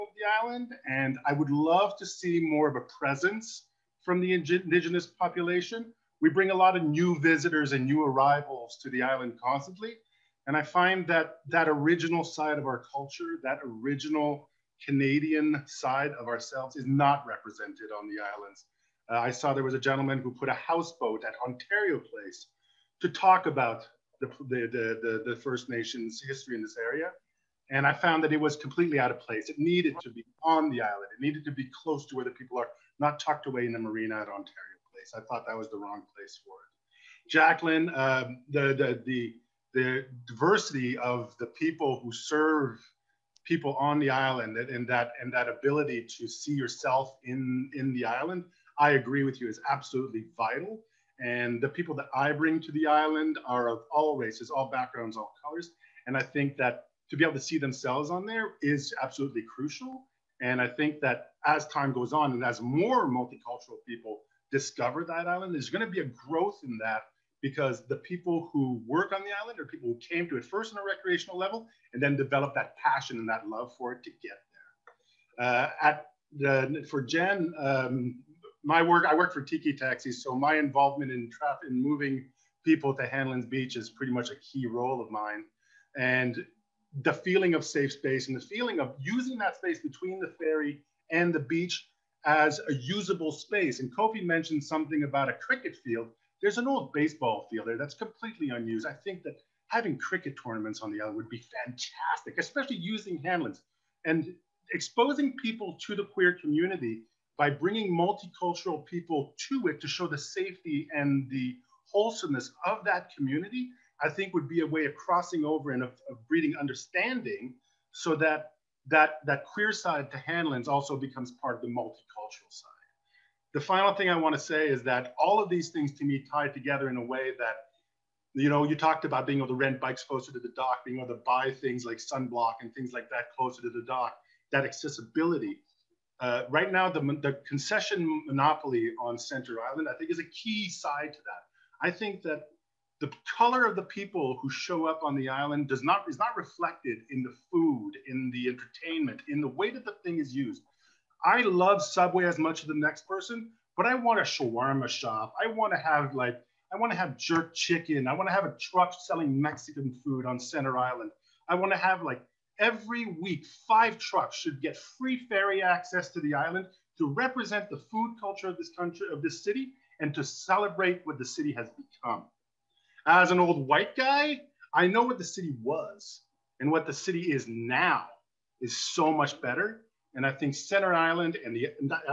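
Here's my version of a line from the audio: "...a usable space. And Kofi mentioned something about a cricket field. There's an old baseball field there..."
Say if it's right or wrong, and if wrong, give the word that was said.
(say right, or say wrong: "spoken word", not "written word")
right.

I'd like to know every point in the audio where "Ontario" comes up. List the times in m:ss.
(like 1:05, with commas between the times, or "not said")
0:21, 0:34.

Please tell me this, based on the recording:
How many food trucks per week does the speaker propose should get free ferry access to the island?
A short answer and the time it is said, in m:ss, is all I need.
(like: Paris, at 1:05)
5, at 2:43.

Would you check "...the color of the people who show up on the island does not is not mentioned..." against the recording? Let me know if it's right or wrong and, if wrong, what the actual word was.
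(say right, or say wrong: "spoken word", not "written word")
wrong: "reflected", not "mentioned".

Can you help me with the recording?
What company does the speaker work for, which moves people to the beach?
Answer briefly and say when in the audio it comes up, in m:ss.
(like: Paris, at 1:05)
Tiki Taxis, at 1:19.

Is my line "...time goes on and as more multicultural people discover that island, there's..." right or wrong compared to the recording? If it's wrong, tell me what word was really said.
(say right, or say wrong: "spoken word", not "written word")
right.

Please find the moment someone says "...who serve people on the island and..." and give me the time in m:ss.
0:42.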